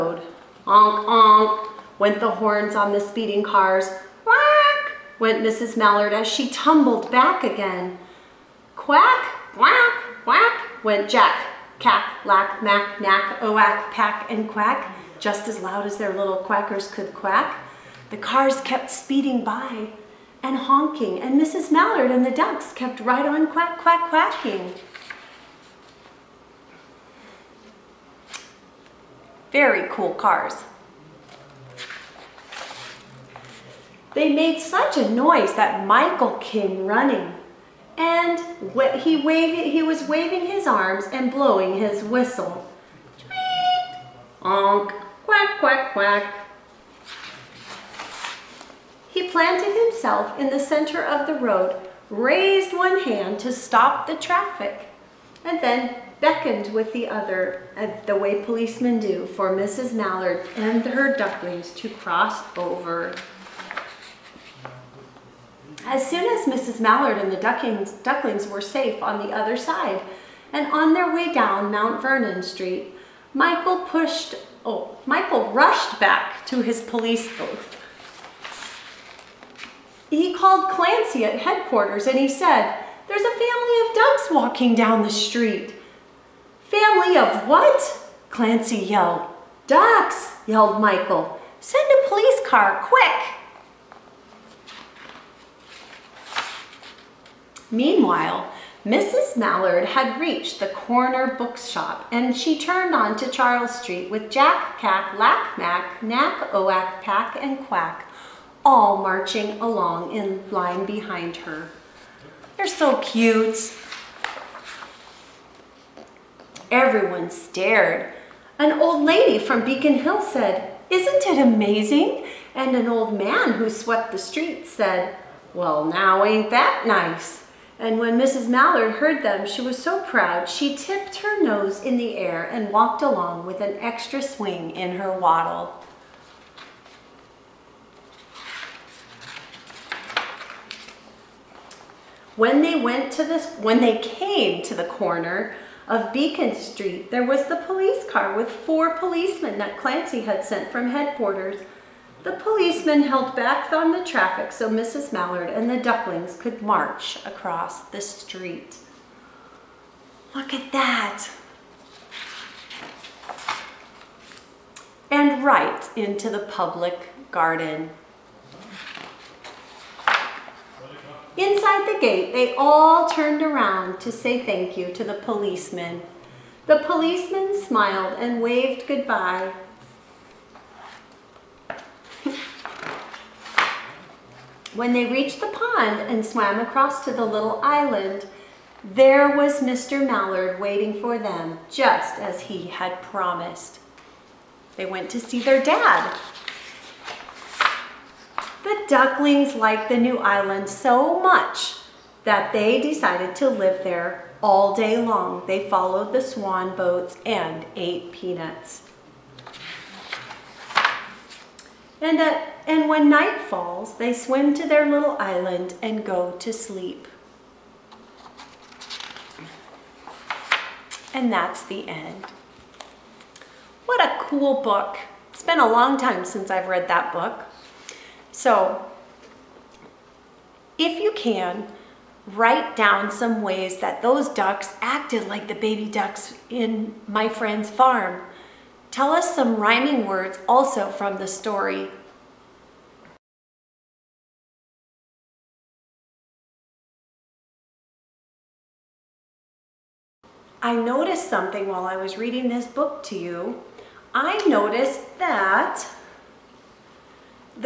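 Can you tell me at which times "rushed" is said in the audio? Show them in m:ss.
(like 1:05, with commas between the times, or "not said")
1:15.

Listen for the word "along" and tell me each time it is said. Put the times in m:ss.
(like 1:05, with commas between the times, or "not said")
1:49, 2:13.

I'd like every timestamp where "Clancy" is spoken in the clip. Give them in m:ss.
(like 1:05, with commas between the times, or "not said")
1:20, 1:28, 2:29.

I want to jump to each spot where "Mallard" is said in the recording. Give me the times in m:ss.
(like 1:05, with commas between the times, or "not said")
0:05, 0:21, 0:59, 1:06, 1:39, 2:08, 2:35, 3:10.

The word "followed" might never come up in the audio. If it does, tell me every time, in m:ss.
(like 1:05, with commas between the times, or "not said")
3:25.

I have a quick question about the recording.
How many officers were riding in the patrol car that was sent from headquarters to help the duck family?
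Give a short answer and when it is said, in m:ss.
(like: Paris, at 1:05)
4, at 2:28.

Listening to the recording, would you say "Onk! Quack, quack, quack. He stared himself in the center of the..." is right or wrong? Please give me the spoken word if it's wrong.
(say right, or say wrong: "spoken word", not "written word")
wrong: "planted", not "stared".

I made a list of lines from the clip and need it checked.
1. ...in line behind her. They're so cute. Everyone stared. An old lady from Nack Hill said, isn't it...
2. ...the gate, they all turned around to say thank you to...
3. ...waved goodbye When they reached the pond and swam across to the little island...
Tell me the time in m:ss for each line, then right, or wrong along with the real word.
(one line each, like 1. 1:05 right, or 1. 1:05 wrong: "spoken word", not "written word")
1. 1:50 wrong: "Beacon", not "Nack"
2. 2:51 right
3. 2:58 right.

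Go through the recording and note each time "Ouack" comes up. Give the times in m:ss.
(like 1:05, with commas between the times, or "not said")
0:13, 1:46.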